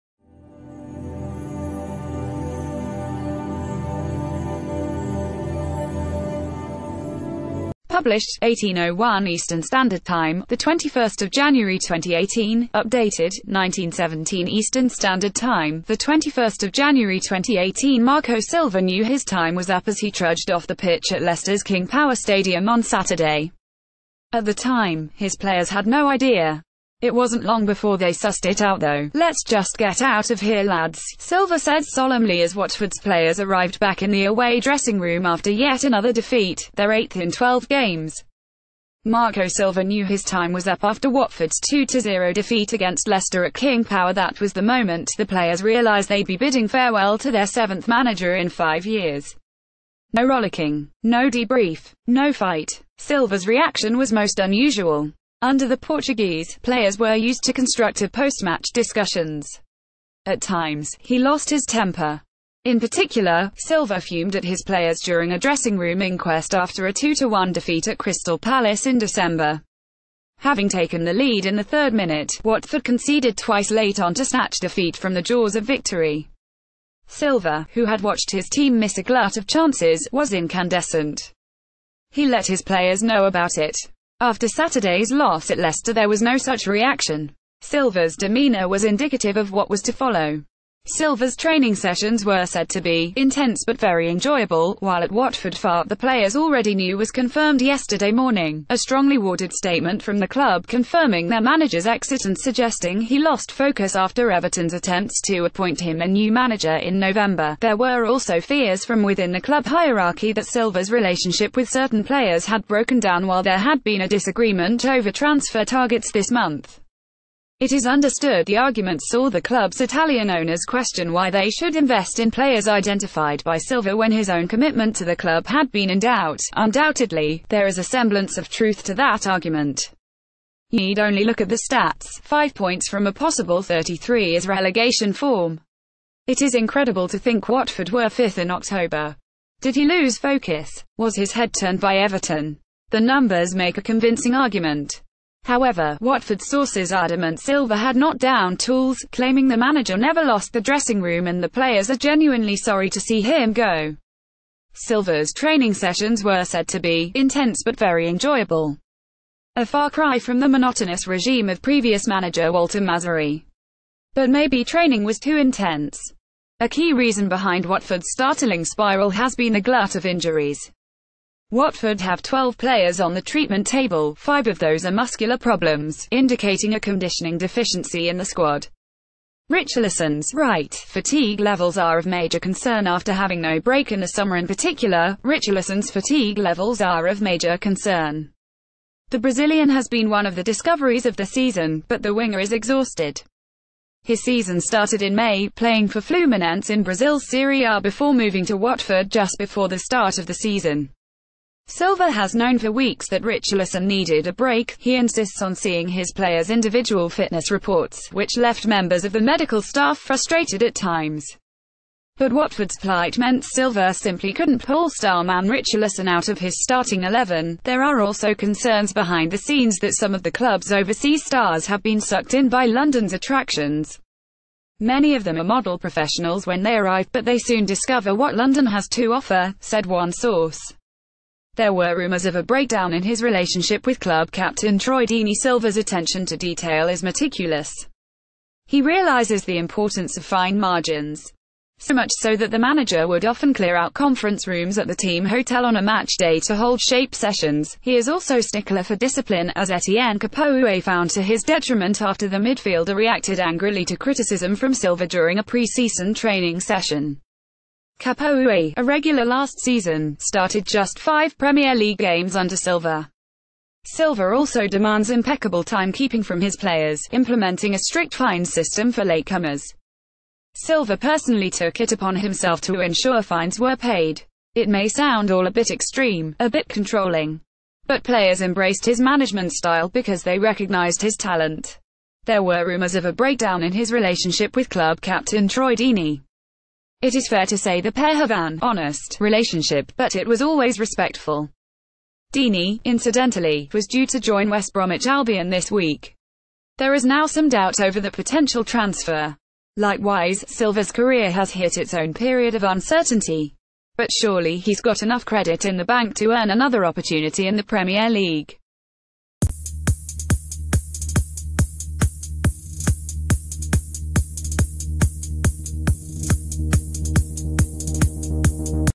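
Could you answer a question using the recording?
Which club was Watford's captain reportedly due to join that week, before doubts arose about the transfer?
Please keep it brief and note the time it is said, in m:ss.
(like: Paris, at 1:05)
West Bromwich Albion, at 4:54.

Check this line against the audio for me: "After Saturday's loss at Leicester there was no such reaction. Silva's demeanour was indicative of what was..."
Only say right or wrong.
right.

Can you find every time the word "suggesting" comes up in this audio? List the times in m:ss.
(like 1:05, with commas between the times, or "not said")
1:42.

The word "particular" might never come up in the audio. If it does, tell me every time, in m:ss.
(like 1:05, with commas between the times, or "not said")
1:02, 3:04.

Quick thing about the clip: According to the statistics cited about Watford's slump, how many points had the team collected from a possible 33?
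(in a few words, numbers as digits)
5.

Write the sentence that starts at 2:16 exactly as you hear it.
It is incredible to think Watford were 5th in October.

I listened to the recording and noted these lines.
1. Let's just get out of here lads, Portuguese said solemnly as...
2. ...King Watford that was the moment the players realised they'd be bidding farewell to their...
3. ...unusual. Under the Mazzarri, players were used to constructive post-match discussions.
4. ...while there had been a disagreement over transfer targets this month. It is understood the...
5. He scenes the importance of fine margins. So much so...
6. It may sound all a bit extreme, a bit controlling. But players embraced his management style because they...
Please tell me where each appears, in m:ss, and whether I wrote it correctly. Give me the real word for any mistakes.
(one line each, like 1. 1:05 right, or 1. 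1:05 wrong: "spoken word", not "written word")
1. 0:29 wrong: "Silva", not "Portuguese"
2. 0:43 wrong: "Power", not "Watford"
3. 0:54 wrong: "Portuguese", not "Mazzarri"
4. 1:53 right
5. 3:58 wrong: "realizes", not "scenes"
6. 4:34 right.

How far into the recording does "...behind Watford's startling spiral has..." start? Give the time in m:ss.
2:47.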